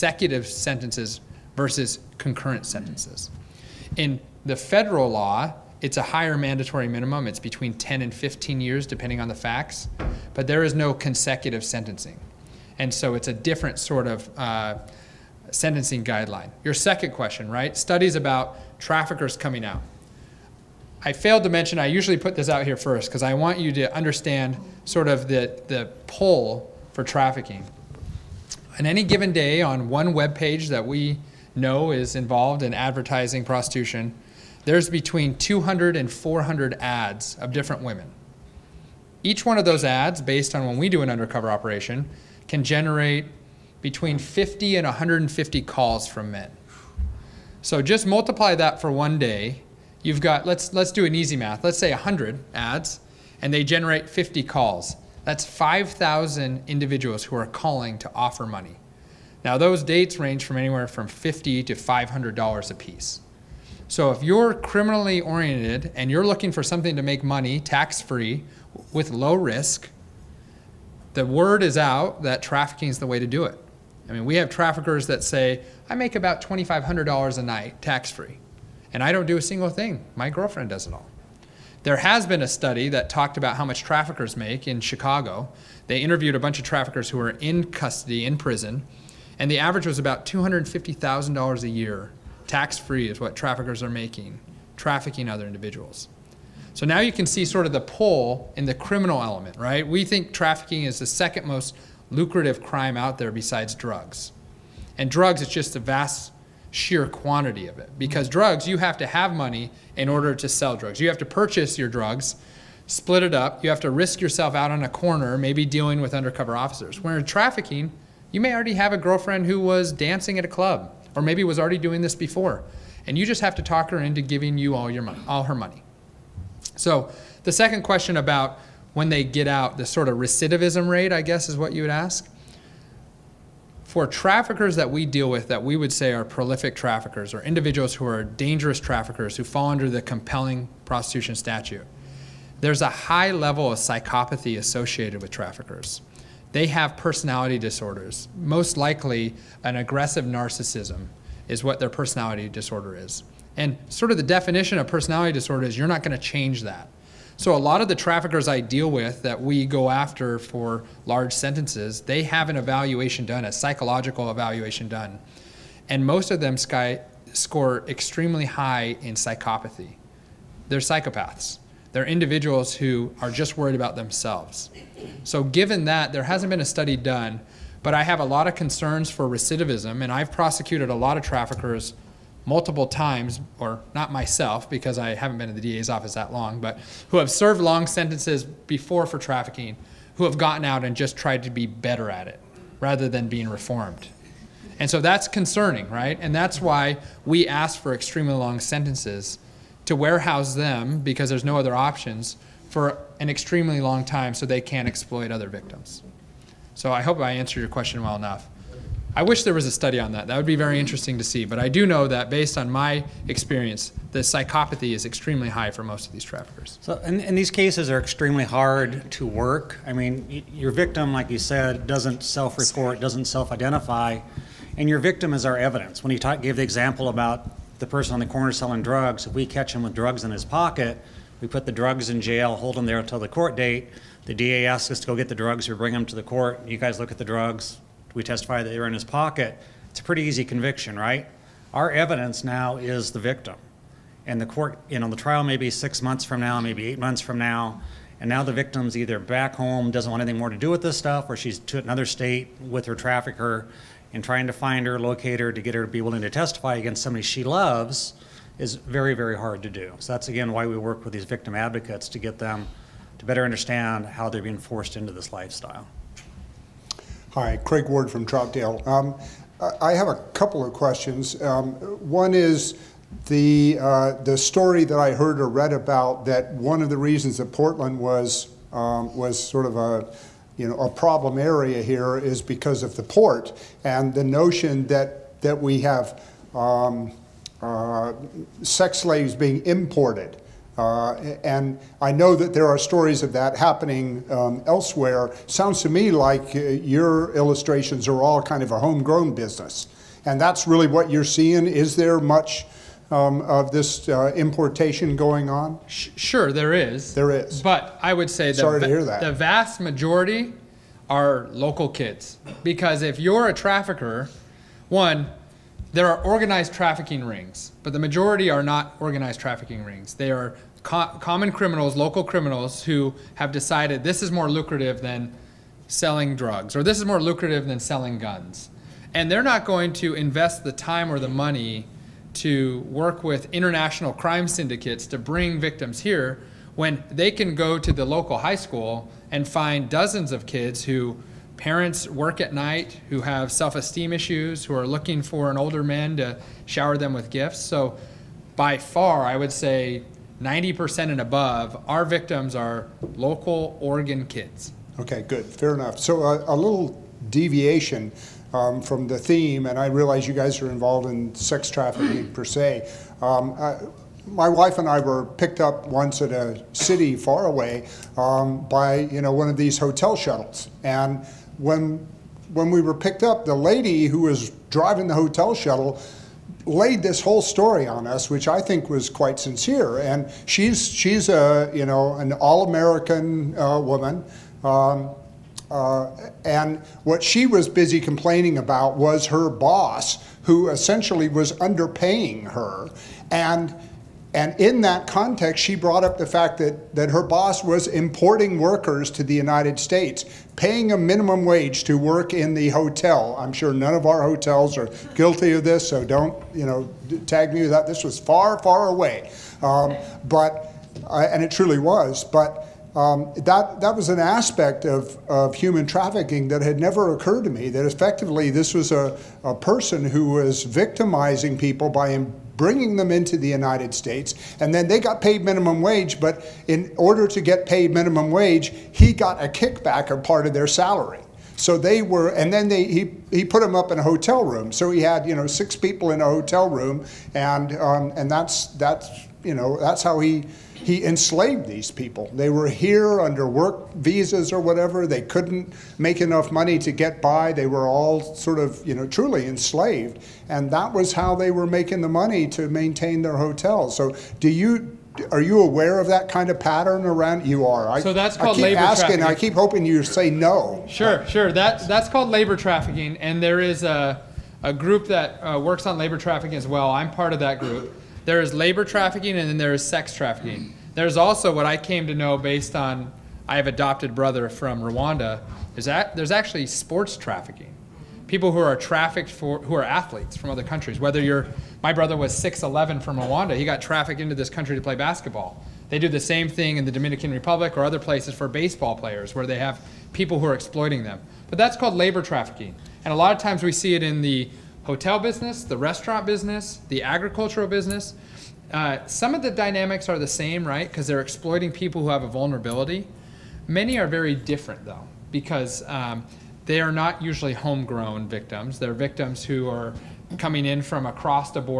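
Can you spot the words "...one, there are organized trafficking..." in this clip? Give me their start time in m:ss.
5:14.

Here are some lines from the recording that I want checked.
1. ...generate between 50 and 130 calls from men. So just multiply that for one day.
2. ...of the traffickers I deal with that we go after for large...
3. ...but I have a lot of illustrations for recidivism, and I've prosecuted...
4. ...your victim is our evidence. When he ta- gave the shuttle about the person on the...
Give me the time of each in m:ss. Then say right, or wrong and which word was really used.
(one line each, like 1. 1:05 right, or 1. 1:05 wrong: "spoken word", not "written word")
1. 0:42 wrong: "150", not "130"
2. 2:37 right
3. 2:57 wrong: "concerns", not "illustrations"
4. 3:44 wrong: "example", not "shuttle".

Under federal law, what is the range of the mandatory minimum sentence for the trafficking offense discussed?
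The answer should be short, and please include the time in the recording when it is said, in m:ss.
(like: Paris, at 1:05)
10 and 15 years, at 0:07.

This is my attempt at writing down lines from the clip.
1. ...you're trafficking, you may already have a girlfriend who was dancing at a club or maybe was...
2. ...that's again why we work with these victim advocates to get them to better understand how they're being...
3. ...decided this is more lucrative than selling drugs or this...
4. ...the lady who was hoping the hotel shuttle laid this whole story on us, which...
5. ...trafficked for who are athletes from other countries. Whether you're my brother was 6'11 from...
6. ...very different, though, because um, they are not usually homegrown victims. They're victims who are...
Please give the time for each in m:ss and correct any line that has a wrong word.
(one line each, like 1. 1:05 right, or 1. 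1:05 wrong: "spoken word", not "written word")
1. 1:57 right
2. 4:20 right
3. 5:23 right
4. 6:13 wrong: "driving", not "hoping"
5. 7:58 right
6. 8:24 right.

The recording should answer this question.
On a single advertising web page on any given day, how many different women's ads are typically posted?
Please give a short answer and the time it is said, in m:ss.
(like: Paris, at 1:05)
200 to 400, at 0:34.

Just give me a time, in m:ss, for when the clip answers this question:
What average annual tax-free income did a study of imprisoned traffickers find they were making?
1:30.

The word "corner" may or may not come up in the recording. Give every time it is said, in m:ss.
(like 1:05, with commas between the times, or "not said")
1:54, 3:48.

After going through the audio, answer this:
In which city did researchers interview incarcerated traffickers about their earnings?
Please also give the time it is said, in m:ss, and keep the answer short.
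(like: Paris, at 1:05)
Chicago, at 1:24.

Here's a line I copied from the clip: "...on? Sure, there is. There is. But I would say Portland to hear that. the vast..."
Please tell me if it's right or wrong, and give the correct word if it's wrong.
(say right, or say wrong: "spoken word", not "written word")
wrong: "Sorry", not "Portland".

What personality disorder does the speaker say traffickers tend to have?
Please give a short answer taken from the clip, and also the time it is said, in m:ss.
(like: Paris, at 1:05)
aggressive narcissism, at 2:29.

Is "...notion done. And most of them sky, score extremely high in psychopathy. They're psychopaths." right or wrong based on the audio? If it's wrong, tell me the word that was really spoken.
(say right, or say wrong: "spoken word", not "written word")
wrong: "evaluation", not "notion".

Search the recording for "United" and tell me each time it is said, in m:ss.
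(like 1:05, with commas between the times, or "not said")
6:39, 7:03.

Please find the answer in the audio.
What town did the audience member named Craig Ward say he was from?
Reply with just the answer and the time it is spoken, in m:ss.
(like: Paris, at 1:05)
Troutdale, at 4:28.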